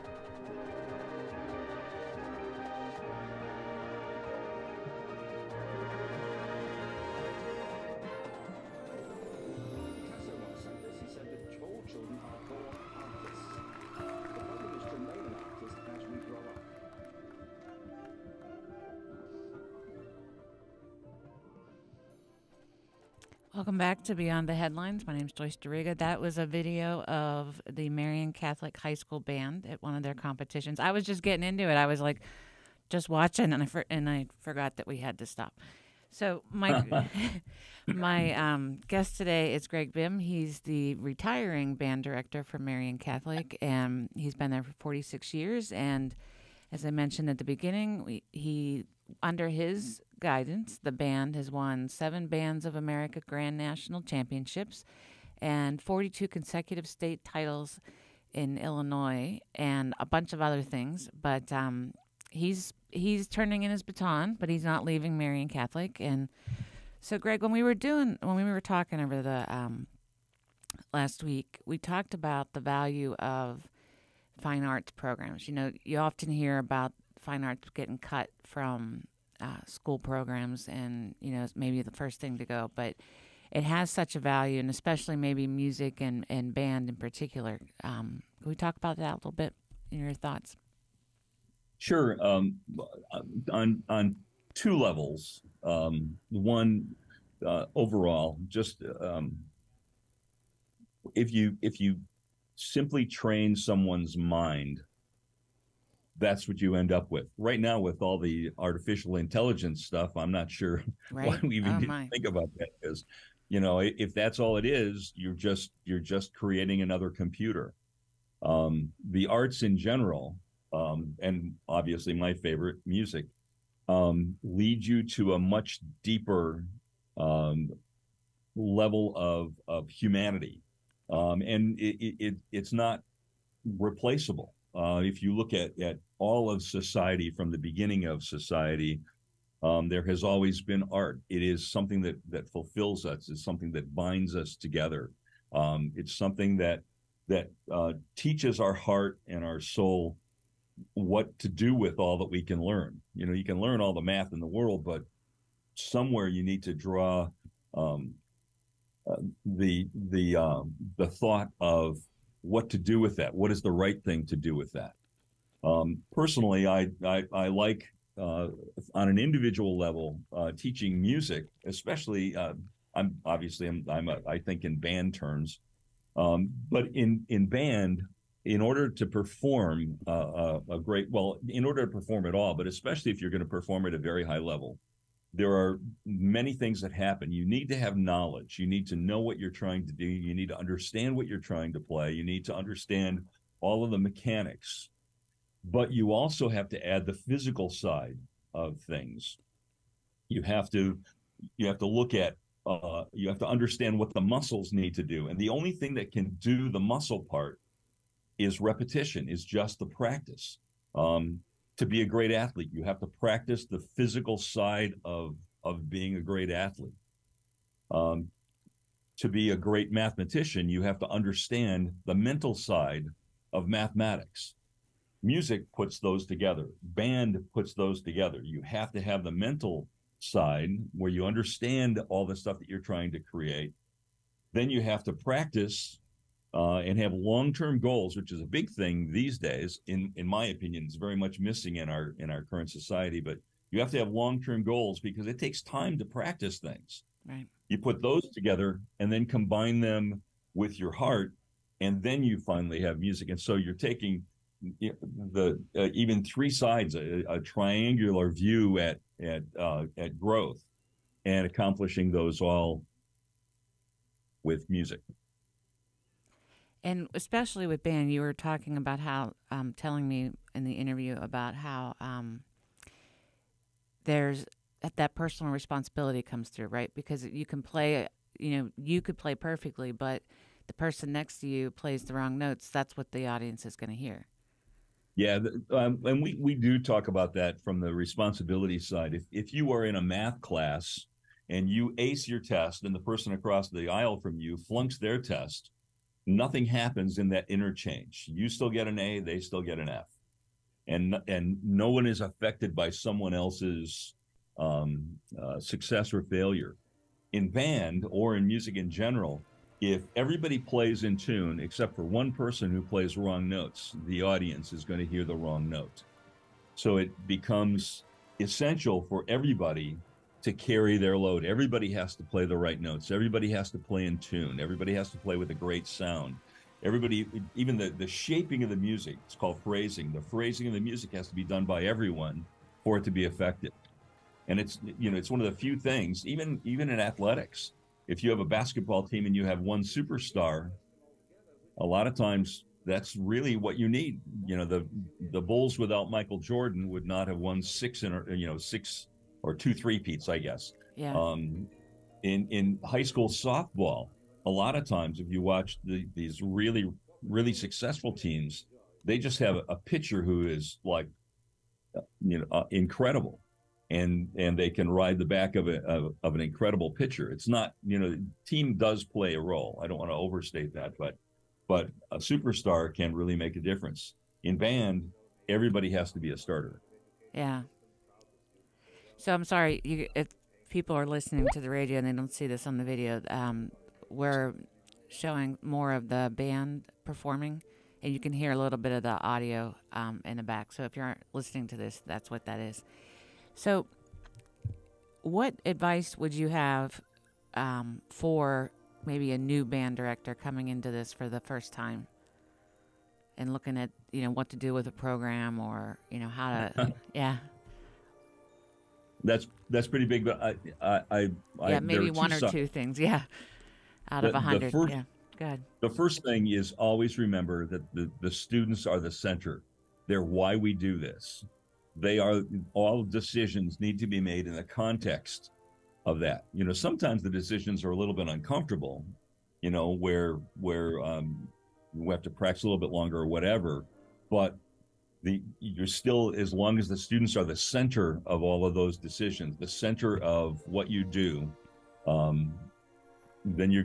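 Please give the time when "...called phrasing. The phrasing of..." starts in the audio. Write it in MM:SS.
05:29.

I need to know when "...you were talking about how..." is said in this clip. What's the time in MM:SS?
04:28.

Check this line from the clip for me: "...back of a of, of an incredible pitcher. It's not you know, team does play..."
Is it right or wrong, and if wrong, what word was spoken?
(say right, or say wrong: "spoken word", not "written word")
right.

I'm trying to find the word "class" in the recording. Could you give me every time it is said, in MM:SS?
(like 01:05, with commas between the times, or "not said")
04:50.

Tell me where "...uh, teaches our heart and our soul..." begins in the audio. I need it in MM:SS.
02:27.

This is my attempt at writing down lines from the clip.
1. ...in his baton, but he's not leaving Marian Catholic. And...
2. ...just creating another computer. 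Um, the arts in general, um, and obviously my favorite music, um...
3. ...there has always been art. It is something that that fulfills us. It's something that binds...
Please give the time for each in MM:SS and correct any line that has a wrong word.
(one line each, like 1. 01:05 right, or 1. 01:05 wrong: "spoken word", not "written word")
1. 01:03 right
2. 01:55 right
3. 02:19 right.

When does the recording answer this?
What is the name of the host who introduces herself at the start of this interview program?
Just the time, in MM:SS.
00:25.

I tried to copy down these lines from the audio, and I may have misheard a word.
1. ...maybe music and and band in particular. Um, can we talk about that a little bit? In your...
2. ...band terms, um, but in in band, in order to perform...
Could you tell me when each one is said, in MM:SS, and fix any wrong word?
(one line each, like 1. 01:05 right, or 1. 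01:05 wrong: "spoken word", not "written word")
1. 01:25 right
2. 02:54 right.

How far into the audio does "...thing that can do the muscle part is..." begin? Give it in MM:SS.
03:25.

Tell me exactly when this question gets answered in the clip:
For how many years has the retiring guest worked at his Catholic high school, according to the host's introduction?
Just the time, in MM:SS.
00:44.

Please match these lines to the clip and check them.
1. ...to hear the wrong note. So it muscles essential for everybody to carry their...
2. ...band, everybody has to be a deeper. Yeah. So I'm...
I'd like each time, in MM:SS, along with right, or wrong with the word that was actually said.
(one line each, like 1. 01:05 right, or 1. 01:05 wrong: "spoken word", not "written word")
1. 05:14 wrong: "becomes", not "muscles"
2. 06:14 wrong: "starter", not "deeper".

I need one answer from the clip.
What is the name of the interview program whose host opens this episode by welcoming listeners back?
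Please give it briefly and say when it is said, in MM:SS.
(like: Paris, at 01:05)
Beyond the Headlines, at 00:24.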